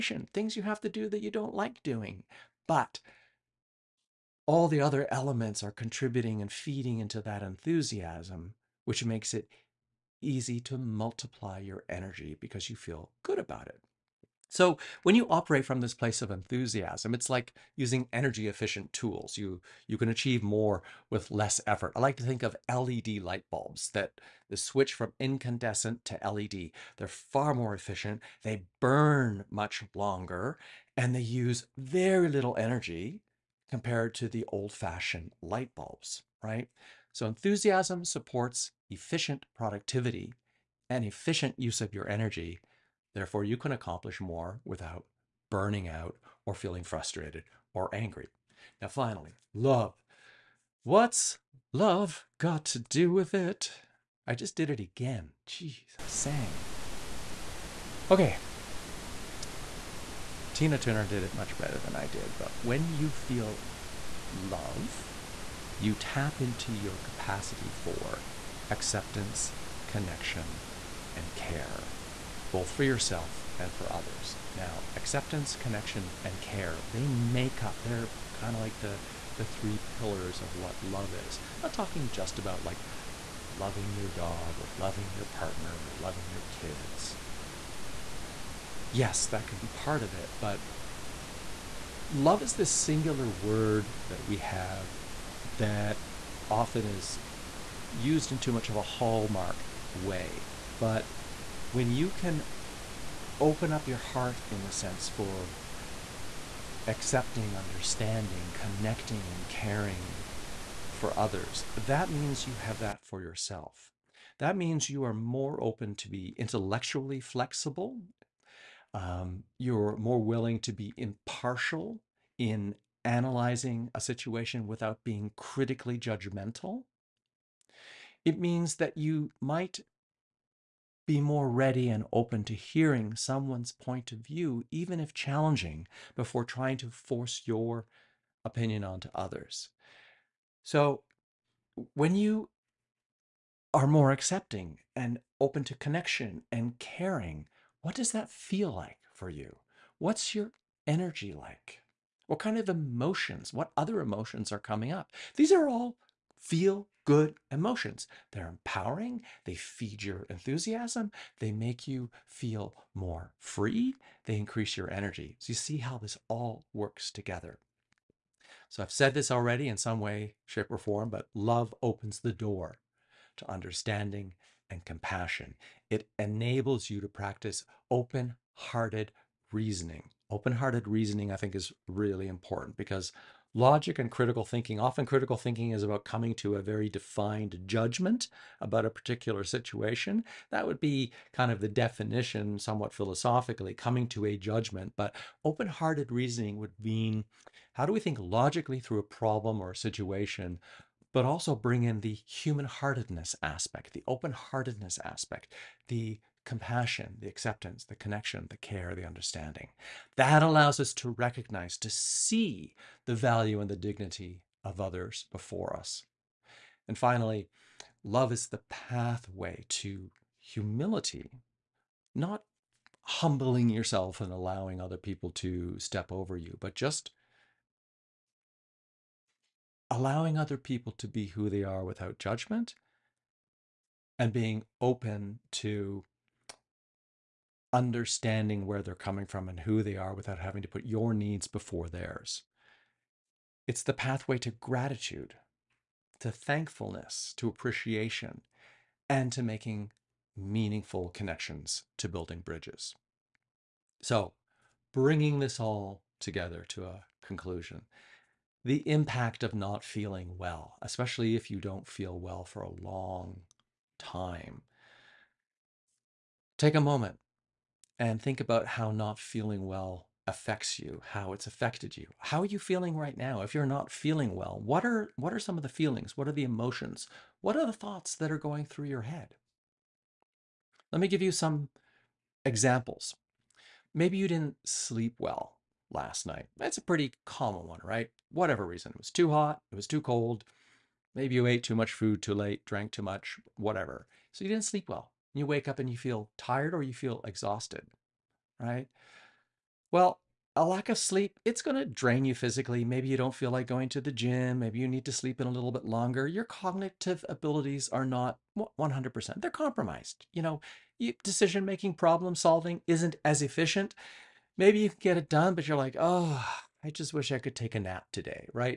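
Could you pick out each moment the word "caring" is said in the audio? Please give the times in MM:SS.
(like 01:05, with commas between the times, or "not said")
01:49, 02:26.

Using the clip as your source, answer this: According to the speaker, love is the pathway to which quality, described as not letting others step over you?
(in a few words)
humility.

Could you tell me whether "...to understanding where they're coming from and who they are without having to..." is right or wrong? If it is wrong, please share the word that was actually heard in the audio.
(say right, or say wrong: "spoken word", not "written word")
right.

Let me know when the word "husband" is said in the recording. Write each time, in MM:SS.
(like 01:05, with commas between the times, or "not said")
not said.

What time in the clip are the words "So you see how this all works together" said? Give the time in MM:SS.
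02:45.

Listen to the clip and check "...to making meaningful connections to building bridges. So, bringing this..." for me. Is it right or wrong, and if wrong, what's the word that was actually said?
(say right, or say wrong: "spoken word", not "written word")
right.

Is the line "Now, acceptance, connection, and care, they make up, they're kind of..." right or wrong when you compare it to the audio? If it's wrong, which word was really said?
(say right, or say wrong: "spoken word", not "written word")
right.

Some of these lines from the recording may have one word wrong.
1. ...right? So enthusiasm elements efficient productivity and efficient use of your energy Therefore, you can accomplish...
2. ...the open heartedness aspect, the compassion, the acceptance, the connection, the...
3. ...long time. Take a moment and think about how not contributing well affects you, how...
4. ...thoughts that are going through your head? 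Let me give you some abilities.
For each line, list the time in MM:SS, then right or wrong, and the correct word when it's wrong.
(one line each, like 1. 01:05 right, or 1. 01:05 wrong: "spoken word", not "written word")
1. 00:36 wrong: "supports", not "elements"
2. 03:23 right
3. 04:22 wrong: "feeling", not "contributing"
4. 04:37 wrong: "examples", not "abilities".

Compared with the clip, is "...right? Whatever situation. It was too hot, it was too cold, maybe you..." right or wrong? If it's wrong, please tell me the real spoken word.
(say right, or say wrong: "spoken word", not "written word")
wrong: "reason", not "situation".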